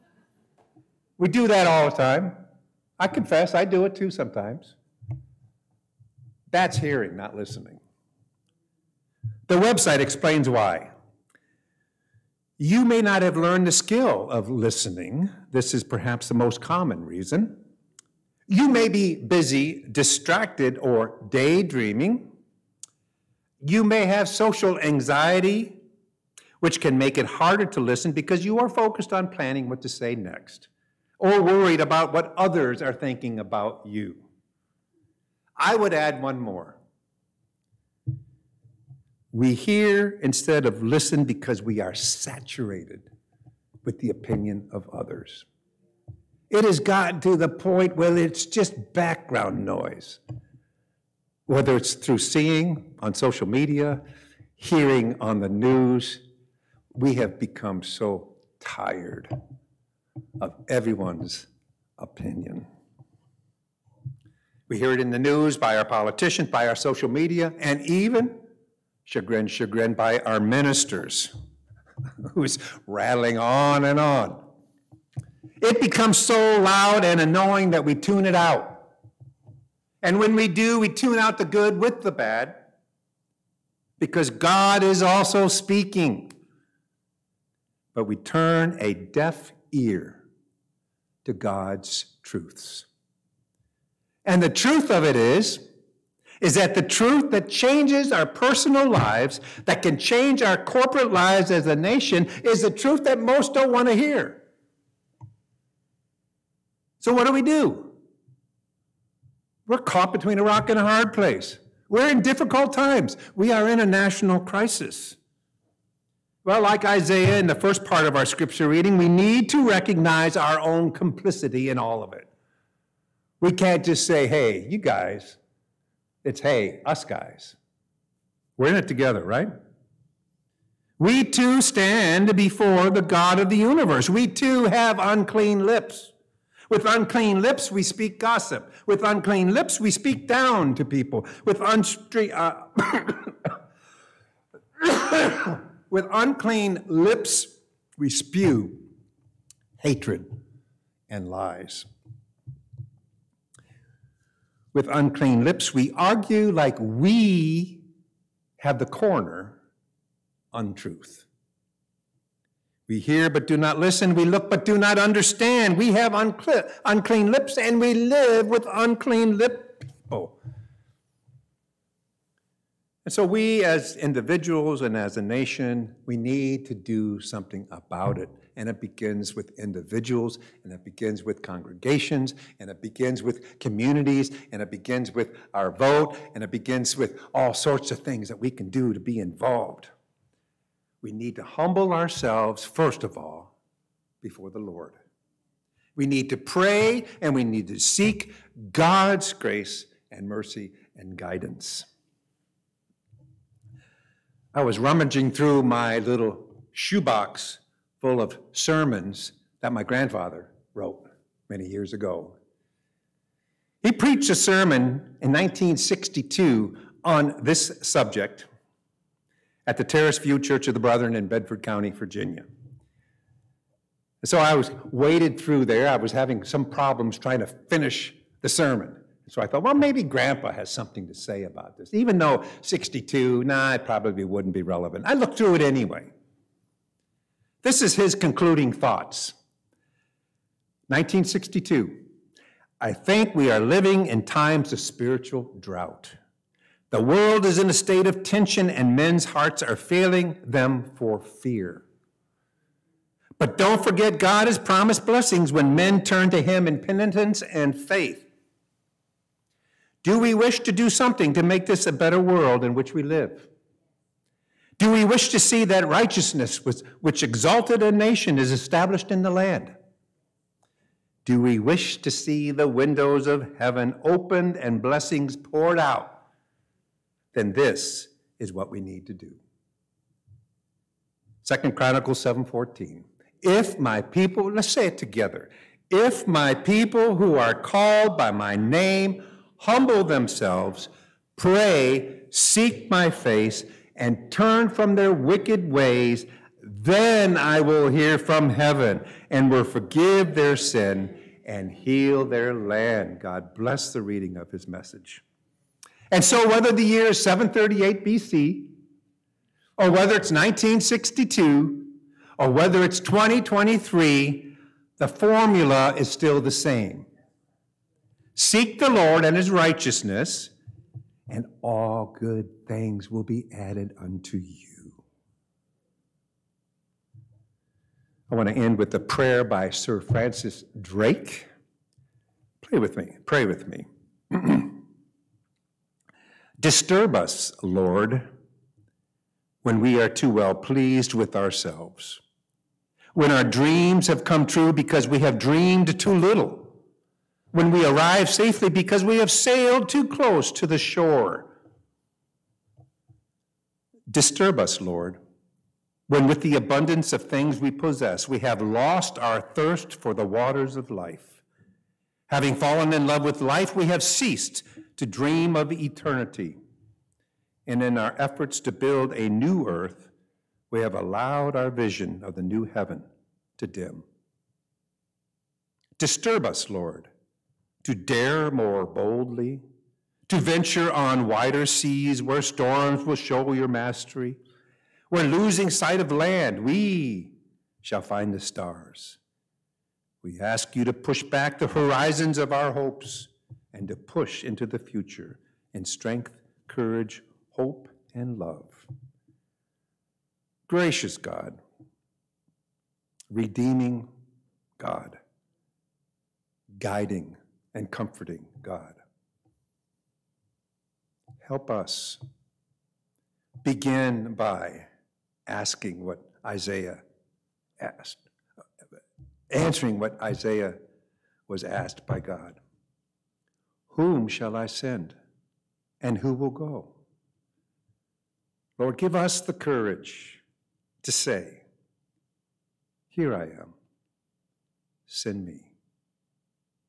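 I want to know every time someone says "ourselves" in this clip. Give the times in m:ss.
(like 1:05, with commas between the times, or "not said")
3:11, 5:41.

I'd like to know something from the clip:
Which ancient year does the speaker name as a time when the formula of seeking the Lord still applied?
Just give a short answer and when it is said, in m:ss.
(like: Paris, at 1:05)
738 BC, at 5:07.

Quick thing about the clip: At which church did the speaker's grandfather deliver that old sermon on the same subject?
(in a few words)
Terrace View Church of the Brethren.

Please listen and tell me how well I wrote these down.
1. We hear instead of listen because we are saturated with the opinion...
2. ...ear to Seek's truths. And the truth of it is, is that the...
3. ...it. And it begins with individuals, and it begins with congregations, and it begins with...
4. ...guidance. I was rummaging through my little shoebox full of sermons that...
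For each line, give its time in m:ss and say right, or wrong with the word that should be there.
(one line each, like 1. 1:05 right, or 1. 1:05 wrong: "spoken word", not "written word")
1. 0:39 right
2. 1:29 wrong: "God", not "Seek"
3. 2:58 right
4. 3:21 right.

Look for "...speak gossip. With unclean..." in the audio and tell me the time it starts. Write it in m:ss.
2:17.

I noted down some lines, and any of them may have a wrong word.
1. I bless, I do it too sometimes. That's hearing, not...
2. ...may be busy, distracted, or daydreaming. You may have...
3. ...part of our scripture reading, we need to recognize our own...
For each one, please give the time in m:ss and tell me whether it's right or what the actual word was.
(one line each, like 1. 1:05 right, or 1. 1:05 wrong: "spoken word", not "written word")
1. 0:02 wrong: "confess", not "bless"
2. 0:18 right
3. 1:57 right.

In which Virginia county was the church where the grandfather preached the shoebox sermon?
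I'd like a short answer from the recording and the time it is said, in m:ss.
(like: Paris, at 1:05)
Bedford County, at 3:41.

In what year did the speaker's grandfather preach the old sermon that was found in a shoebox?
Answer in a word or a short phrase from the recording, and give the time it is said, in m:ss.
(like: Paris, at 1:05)
1962, at 3:35.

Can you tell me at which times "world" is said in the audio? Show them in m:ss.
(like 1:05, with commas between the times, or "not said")
4:07, 4:22.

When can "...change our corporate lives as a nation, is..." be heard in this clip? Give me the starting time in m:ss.
1:39.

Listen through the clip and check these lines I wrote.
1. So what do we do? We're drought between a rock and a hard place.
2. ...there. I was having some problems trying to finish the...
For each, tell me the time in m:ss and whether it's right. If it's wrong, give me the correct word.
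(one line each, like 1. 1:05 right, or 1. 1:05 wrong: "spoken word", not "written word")
1. 1:47 wrong: "caught", not "drought"
2. 3:45 right.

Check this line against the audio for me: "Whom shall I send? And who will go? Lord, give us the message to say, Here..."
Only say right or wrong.
wrong.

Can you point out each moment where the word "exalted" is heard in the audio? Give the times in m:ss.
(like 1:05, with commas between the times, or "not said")
4:27.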